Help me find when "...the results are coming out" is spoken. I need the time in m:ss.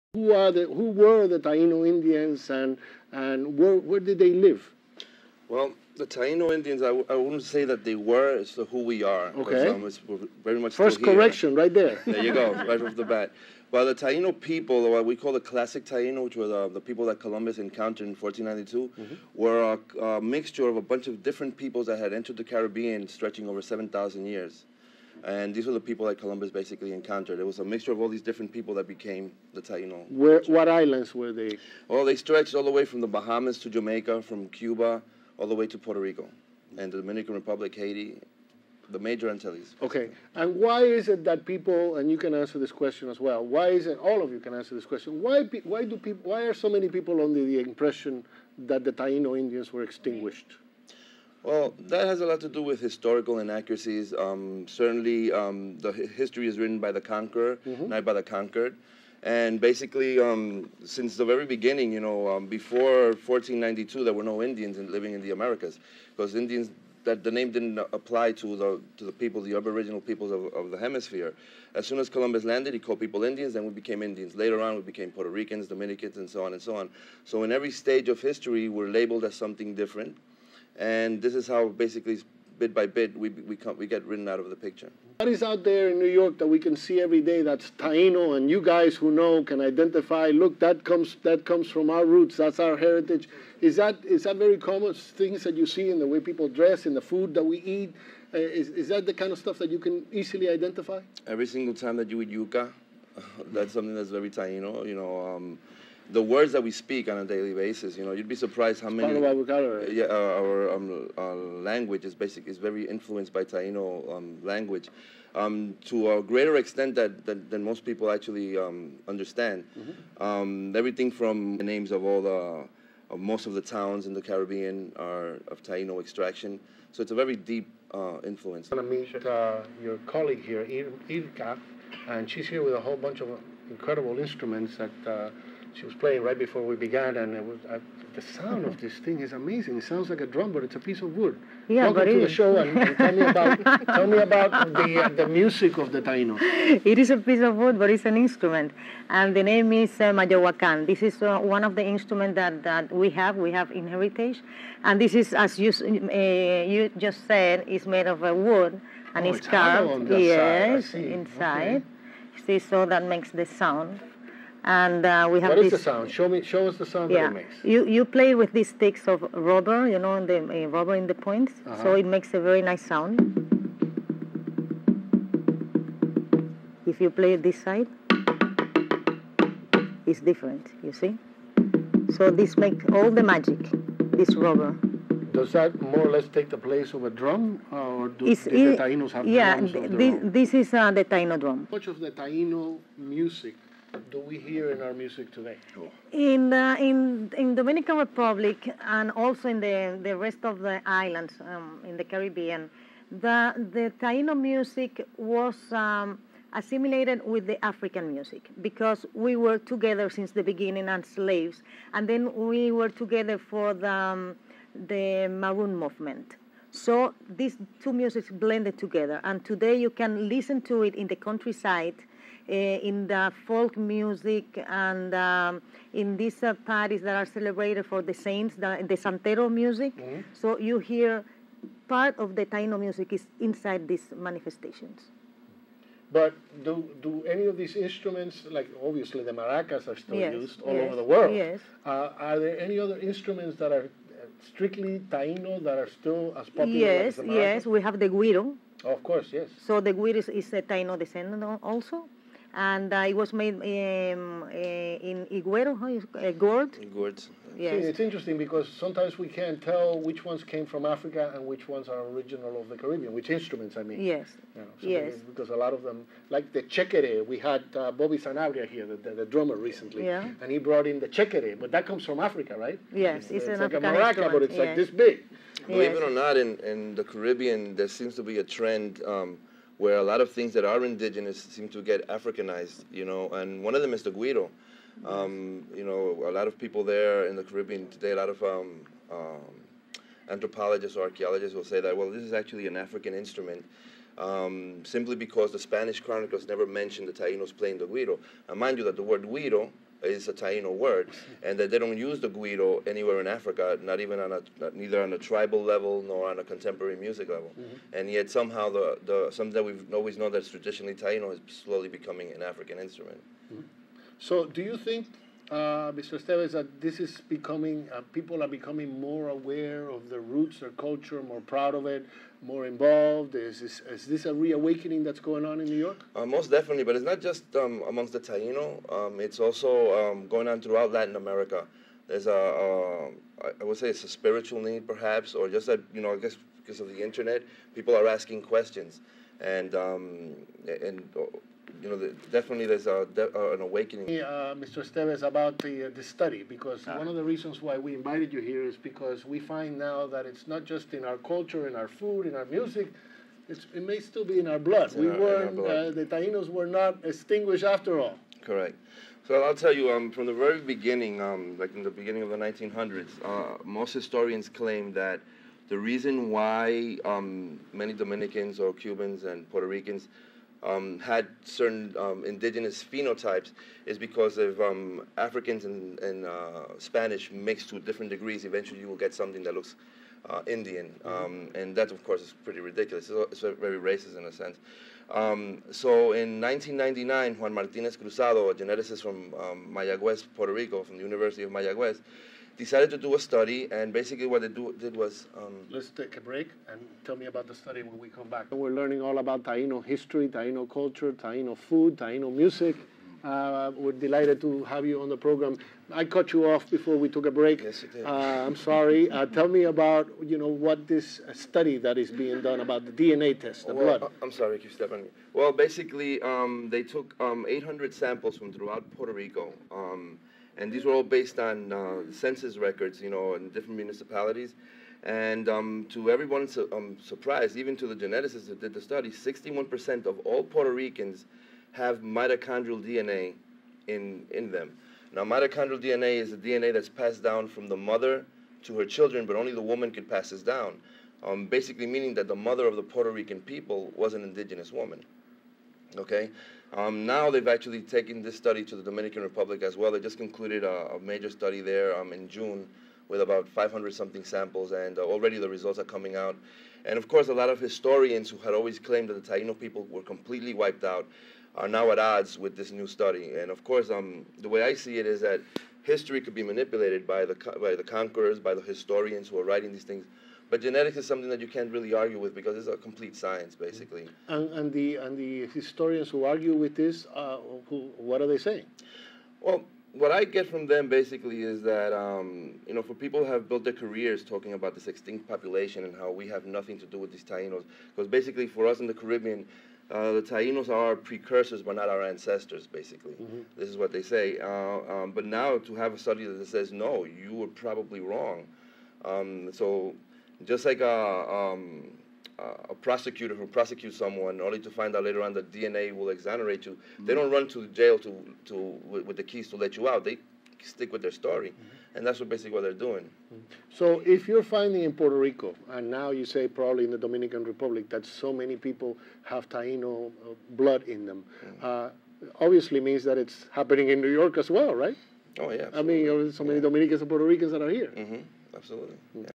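7:35.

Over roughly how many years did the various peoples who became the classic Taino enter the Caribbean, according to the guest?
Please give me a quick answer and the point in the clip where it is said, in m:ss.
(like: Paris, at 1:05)
7,000 years, at 0:23.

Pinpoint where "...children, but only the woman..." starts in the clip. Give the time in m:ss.
7:18.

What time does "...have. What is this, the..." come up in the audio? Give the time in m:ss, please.
2:45.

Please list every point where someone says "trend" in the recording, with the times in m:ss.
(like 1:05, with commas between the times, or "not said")
4:38.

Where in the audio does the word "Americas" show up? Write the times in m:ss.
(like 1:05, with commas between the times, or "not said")
1:05, 5:31.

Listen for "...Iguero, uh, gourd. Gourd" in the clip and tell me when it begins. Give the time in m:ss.
4:15.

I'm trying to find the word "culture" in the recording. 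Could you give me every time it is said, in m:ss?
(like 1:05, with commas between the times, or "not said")
5:20, 5:51, 6:40.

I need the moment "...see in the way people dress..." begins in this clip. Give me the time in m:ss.
1:35.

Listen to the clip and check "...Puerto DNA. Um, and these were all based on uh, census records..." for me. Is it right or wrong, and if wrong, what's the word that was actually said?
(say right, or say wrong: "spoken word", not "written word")
wrong: "Rico", not "DNA".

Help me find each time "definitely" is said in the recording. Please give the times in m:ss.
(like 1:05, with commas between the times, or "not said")
5:26, 5:42.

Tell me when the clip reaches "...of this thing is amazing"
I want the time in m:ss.
2:18.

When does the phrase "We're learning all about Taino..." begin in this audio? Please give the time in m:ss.
6:38.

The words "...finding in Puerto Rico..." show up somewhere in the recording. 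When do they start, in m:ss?
8:34.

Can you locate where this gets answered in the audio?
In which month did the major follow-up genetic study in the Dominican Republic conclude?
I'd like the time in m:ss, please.
7:32.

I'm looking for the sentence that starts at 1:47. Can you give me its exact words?
You know, you'd be surprised how it's many.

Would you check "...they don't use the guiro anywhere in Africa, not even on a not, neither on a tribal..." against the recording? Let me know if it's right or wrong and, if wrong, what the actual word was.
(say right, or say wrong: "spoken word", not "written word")
right.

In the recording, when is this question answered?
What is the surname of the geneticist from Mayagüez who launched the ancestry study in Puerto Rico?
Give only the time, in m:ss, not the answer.
6:27.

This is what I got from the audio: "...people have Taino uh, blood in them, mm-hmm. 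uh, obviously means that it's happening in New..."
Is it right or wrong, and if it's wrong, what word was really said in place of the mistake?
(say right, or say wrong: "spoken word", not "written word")
right.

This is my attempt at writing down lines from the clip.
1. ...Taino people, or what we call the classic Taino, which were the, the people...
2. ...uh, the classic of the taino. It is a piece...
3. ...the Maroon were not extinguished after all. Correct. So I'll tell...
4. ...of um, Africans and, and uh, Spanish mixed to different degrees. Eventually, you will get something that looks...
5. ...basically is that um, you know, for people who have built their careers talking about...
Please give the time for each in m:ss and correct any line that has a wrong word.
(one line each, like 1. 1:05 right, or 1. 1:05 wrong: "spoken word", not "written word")
1. 0:13 right
2. 2:25 wrong: "music", not "classic"
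3. 5:55 wrong: "Tainos", not "Maroon"
4. 6:14 right
5. 8:00 right.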